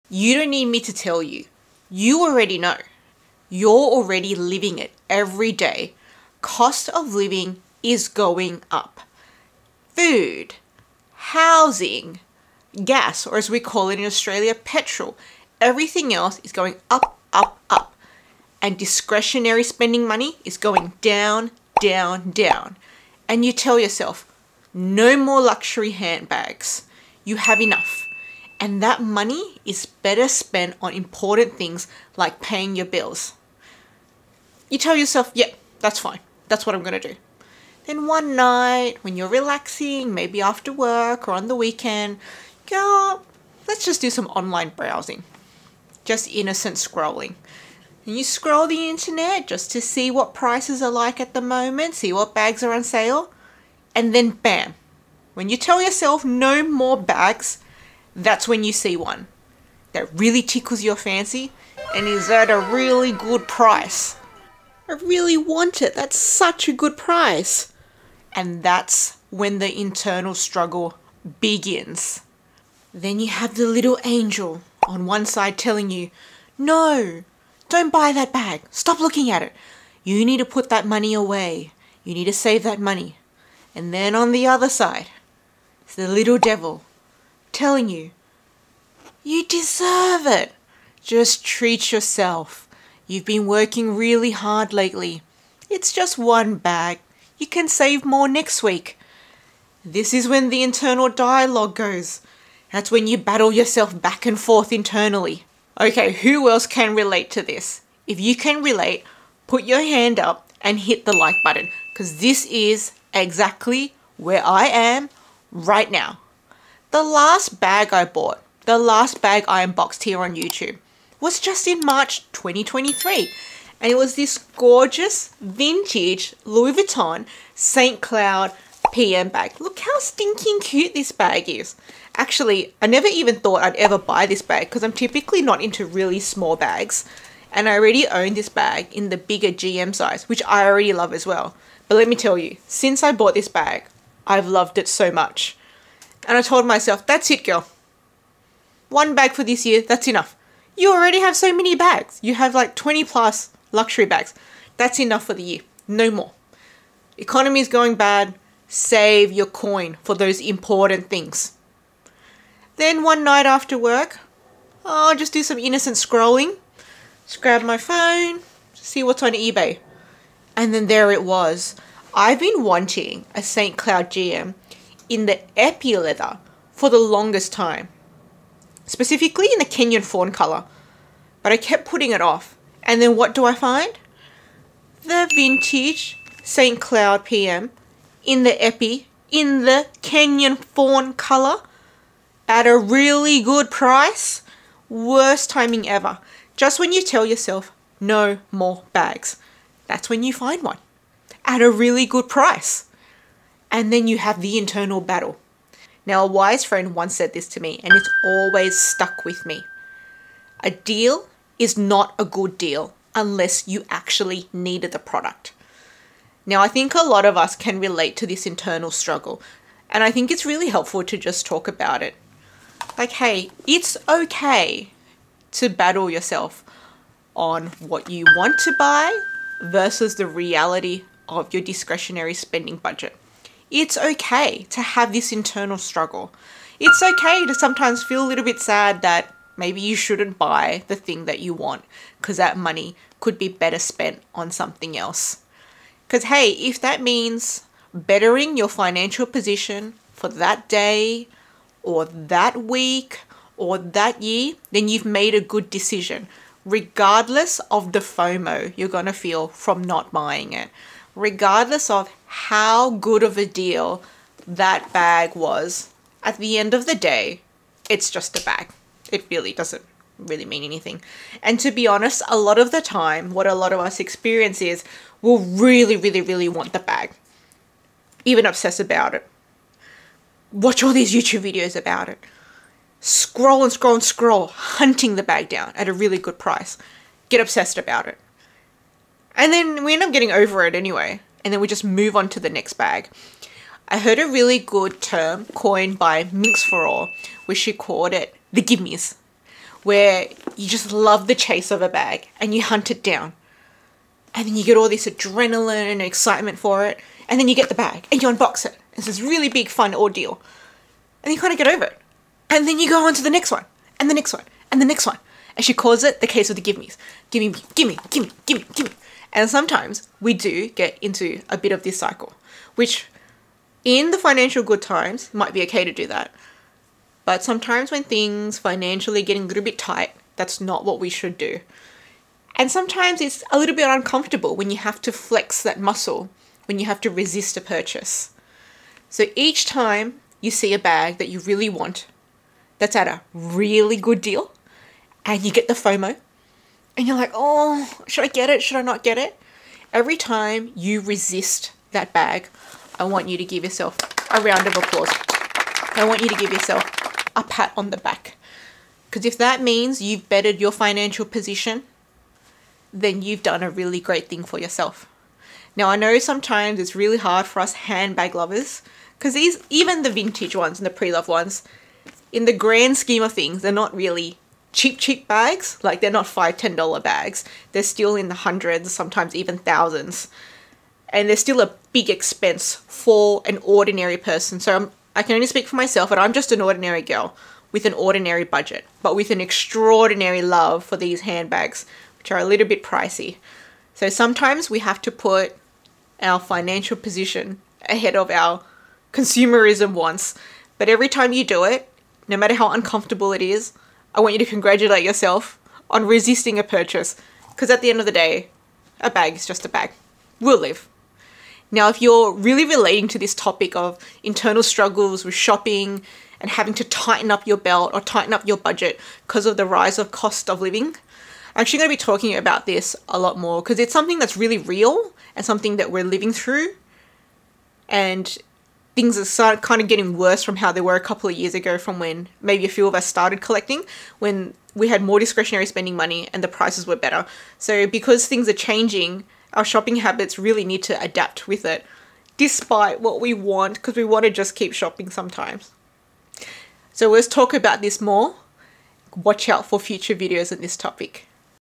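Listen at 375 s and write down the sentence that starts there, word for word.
Like they're not five, ten dollar bags.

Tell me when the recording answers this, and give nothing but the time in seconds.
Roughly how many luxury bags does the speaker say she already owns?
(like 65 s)
152 s.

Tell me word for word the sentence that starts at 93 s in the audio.
You've been working really hard lately.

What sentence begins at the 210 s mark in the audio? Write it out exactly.
A deal is not a good deal unless you actually needed the product.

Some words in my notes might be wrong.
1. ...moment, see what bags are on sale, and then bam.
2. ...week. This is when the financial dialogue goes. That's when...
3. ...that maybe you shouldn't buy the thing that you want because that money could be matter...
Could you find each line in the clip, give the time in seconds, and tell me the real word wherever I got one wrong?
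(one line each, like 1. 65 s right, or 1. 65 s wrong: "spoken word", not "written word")
1. 51 s right
2. 98 s wrong: "internal", not "financial"
3. 239 s wrong: "better", not "matter".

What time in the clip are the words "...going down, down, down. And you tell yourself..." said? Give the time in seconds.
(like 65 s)
20 s.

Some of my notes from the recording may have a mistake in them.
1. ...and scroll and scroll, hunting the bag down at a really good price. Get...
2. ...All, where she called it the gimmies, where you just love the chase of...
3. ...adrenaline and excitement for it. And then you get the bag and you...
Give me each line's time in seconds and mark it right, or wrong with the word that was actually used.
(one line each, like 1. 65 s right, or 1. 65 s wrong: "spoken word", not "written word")
1. 283 s right
2. 296 s right
3. 305 s right.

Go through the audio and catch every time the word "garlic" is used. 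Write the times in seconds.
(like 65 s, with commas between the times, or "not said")
not said.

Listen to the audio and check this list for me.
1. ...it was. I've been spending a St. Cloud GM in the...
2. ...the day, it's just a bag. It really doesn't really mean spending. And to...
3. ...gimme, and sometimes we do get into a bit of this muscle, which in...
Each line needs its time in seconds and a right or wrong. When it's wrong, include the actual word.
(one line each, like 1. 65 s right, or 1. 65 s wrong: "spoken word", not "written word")
1. 171 s wrong: "wanting", not "spending"
2. 266 s wrong: "anything", not "spending"
3. 318 s wrong: "cycle", not "muscle".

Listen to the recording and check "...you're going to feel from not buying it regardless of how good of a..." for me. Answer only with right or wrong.
right.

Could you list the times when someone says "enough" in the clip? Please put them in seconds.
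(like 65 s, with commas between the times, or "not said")
27 s, 150 s, 154 s.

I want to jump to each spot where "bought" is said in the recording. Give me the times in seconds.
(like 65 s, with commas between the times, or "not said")
118 s, 143 s.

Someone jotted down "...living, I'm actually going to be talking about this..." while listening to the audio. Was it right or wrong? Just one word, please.
right.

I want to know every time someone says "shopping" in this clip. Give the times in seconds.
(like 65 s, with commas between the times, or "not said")
415 s, 439 s, 444 s.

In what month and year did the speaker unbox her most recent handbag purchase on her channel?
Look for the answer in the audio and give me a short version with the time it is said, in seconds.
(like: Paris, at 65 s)
March 2023, at 121 s.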